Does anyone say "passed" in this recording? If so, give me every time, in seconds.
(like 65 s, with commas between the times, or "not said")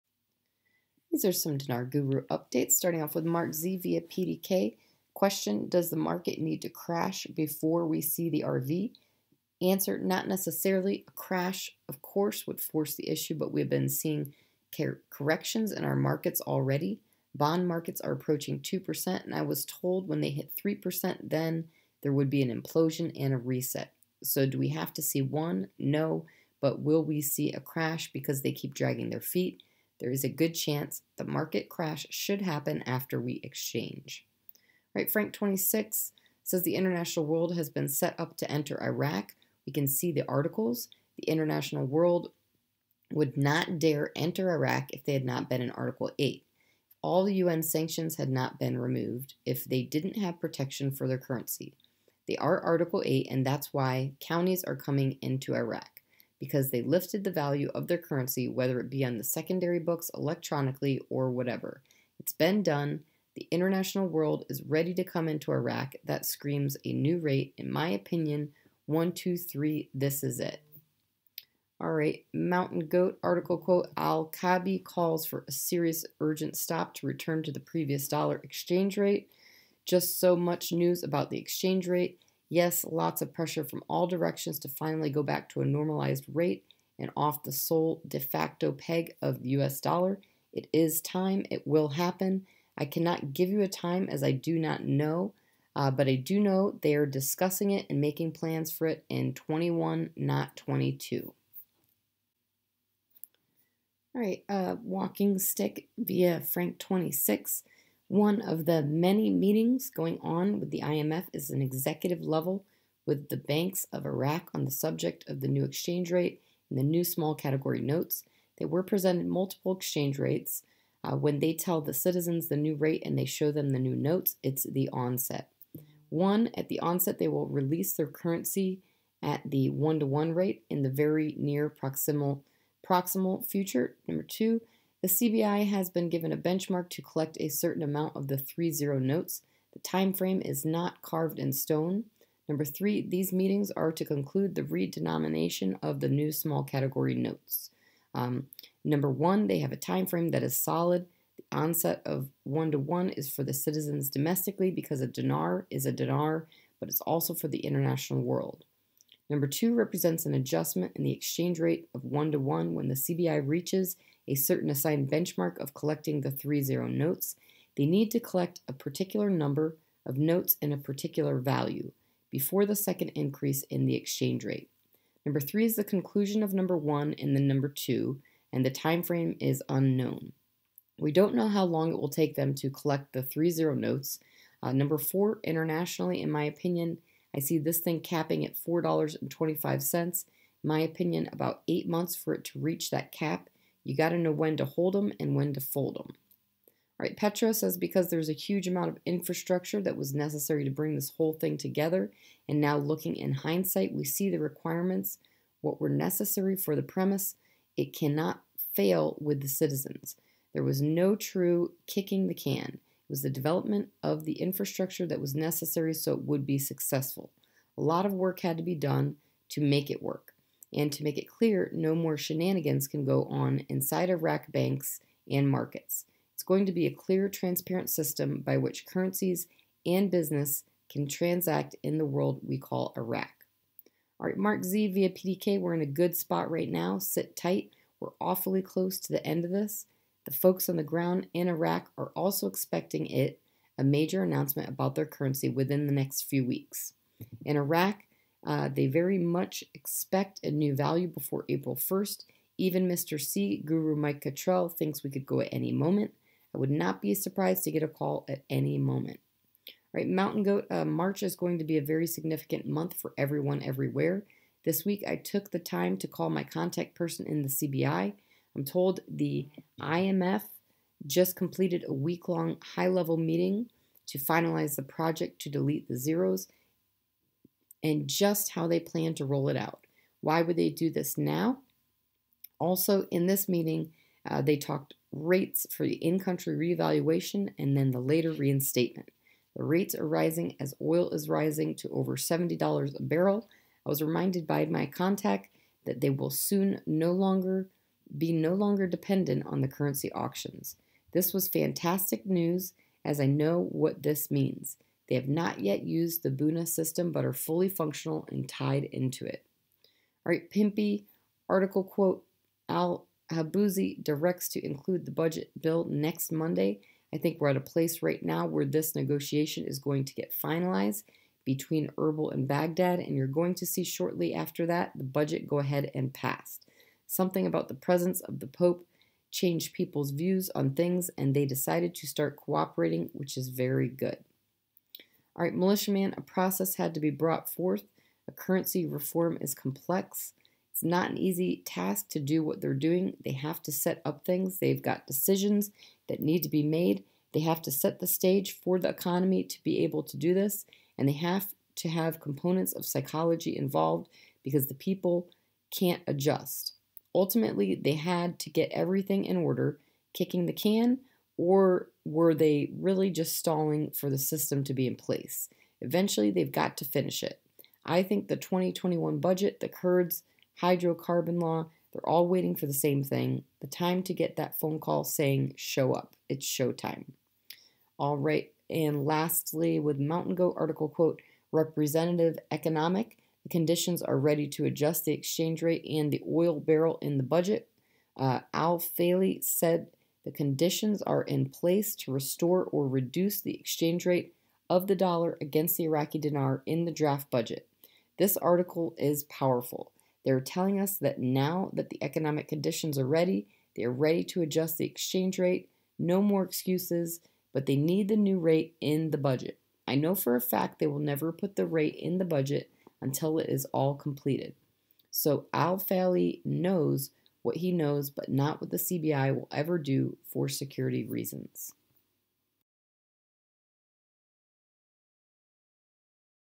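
326 s.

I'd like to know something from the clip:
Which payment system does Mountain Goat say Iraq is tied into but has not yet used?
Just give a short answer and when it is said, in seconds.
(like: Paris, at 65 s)
Buna system, at 306 s.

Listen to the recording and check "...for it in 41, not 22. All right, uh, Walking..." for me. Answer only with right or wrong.
wrong.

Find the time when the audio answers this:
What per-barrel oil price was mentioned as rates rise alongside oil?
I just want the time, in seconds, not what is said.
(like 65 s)
292 s.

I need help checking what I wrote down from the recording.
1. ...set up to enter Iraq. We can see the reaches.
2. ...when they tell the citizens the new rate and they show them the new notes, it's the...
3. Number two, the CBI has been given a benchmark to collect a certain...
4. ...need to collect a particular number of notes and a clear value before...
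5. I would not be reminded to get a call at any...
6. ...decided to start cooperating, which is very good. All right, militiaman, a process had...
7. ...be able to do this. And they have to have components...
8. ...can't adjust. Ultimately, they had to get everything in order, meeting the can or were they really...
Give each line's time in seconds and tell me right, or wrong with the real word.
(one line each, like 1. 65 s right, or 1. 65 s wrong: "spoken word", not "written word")
1. 37 s wrong: "articles", not "reaches"
2. 121 s right
3. 134 s right
4. 167 s wrong: "particular", not "clear"
5. 256 s wrong: "surprised", not "reminded"
6. 331 s right
7. 349 s right
8. 355 s wrong: "kicking", not "meeting".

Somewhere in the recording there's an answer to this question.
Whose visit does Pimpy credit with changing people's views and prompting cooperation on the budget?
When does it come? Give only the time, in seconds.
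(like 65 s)
328 s.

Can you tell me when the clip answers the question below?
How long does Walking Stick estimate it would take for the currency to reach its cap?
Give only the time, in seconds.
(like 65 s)
191 s.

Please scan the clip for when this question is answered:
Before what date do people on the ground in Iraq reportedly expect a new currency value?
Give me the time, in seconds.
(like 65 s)
251 s.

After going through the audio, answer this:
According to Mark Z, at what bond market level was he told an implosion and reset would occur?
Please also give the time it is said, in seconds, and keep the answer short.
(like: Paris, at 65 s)
3%, at 20 s.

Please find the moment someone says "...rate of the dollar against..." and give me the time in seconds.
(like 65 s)
394 s.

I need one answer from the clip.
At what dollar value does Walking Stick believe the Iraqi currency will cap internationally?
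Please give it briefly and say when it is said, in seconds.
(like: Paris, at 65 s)
$4.25, at 188 s.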